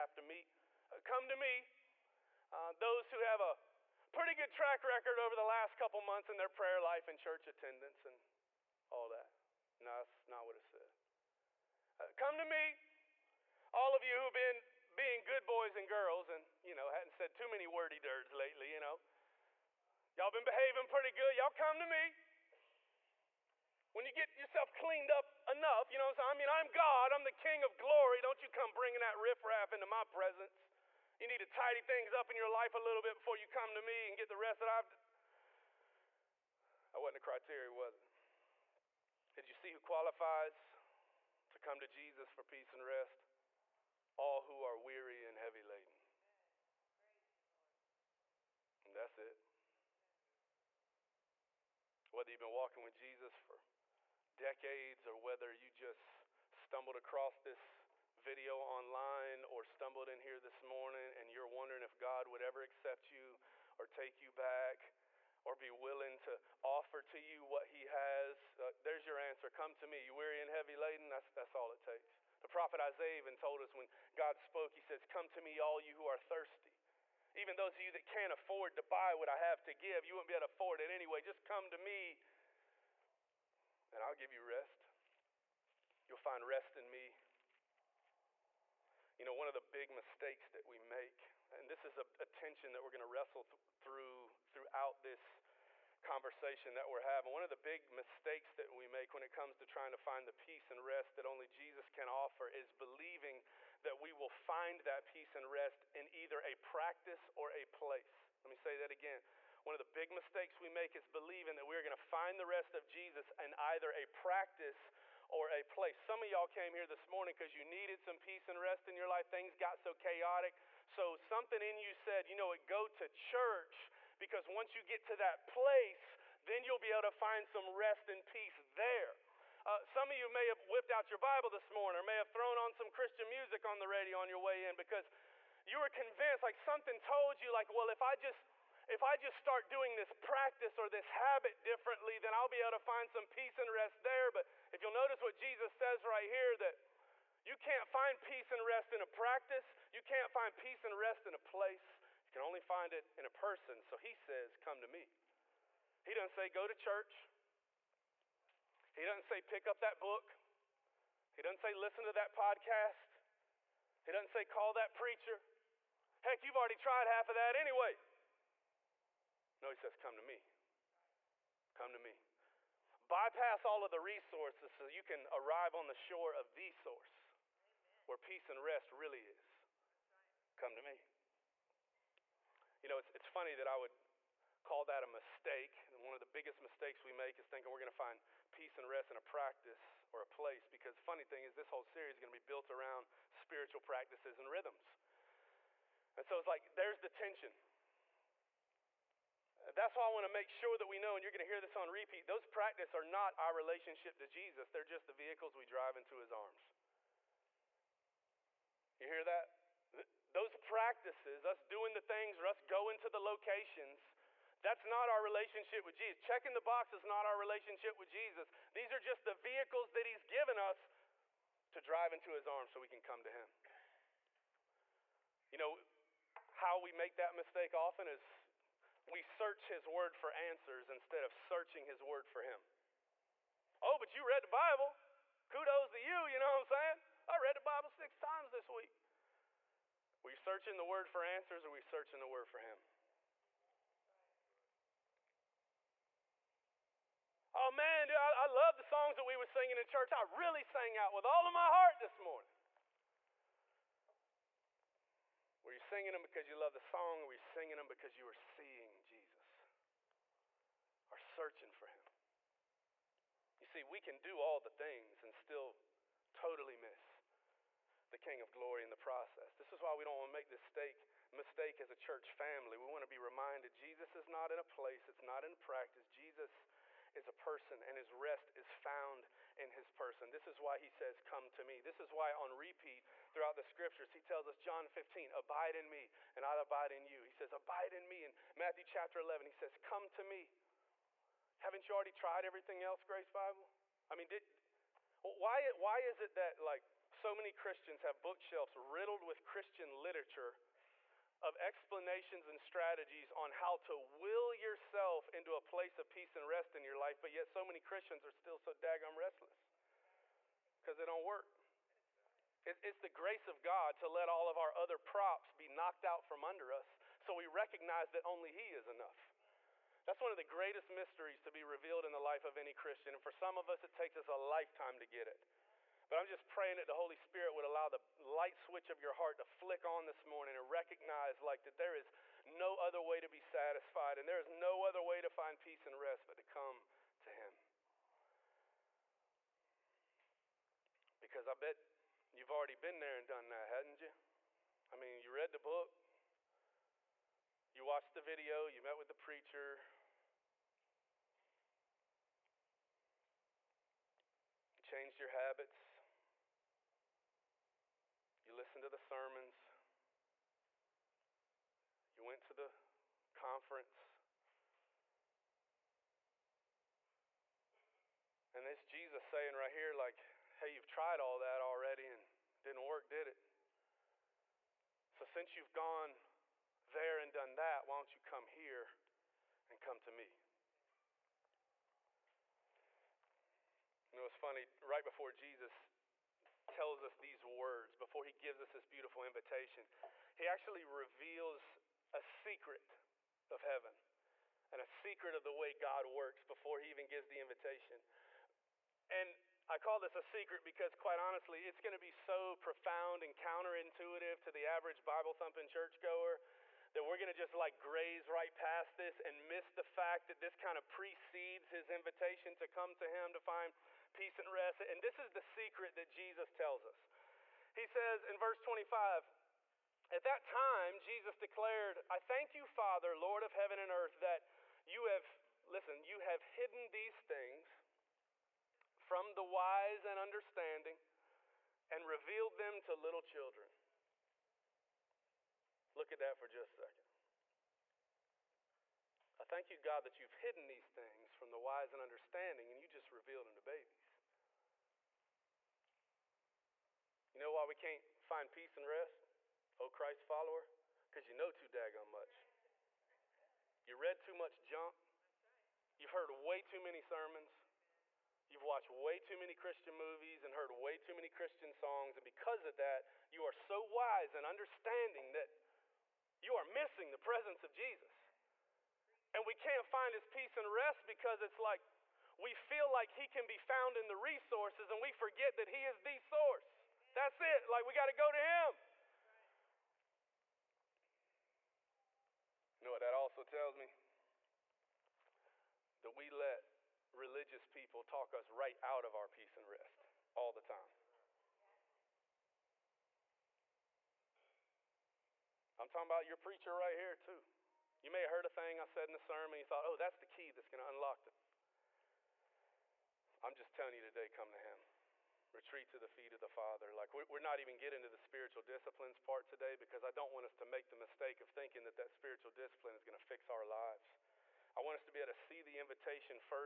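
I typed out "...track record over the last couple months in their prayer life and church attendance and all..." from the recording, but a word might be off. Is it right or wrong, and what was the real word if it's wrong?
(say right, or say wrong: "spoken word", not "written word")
right.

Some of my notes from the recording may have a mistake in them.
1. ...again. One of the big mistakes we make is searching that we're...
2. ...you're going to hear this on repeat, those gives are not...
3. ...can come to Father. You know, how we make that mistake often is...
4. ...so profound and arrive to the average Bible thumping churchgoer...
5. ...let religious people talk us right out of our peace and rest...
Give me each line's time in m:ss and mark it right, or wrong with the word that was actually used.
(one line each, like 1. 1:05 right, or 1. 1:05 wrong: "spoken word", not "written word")
1. 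1:48 wrong: "believing", not "searching"
2. 3:21 wrong: "practices", not "gives"
3. 3:42 wrong: "Him", not "Father"
4. 6:42 wrong: "counterintuitive", not "arrive"
5. 8:06 right.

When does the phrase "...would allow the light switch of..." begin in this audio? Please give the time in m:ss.
5:27.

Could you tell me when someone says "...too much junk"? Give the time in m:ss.
7:34.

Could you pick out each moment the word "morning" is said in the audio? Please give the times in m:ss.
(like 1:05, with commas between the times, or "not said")
1:00, 1:57, 2:11, 4:12, 5:30.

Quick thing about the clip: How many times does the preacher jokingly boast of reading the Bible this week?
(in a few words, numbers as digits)
6.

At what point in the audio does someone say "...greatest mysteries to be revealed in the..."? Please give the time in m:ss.
5:20.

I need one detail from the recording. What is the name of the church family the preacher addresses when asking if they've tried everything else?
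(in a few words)
Grace Bible.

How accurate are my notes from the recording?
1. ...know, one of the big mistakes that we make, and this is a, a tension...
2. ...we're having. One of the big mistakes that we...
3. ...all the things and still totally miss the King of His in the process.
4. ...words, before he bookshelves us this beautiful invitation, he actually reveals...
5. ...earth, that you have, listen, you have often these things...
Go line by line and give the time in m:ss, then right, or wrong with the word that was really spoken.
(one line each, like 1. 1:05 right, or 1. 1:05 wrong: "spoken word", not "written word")
1. 1:29 right
2. 1:36 right
3. 4:24 wrong: "Glory", not "His"
4. 6:27 wrong: "gives", not "bookshelves"
5. 7:03 wrong: "hidden", not "often".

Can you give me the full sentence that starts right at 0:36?
That wasn't a criteria, was it?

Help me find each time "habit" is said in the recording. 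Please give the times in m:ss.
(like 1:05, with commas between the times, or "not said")
2:21, 5:55.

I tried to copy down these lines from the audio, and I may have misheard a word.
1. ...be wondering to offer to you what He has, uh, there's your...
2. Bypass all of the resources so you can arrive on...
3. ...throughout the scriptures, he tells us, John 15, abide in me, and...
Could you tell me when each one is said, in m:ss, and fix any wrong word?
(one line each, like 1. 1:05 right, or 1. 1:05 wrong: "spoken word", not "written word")
1. 1:05 wrong: "willing", not "wondering"
2. 2:53 right
3. 4:43 right.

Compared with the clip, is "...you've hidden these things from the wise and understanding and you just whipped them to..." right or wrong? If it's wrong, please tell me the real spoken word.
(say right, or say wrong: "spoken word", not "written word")
wrong: "revealed", not "whipped".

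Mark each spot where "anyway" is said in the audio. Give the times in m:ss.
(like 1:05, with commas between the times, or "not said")
1:20, 2:47.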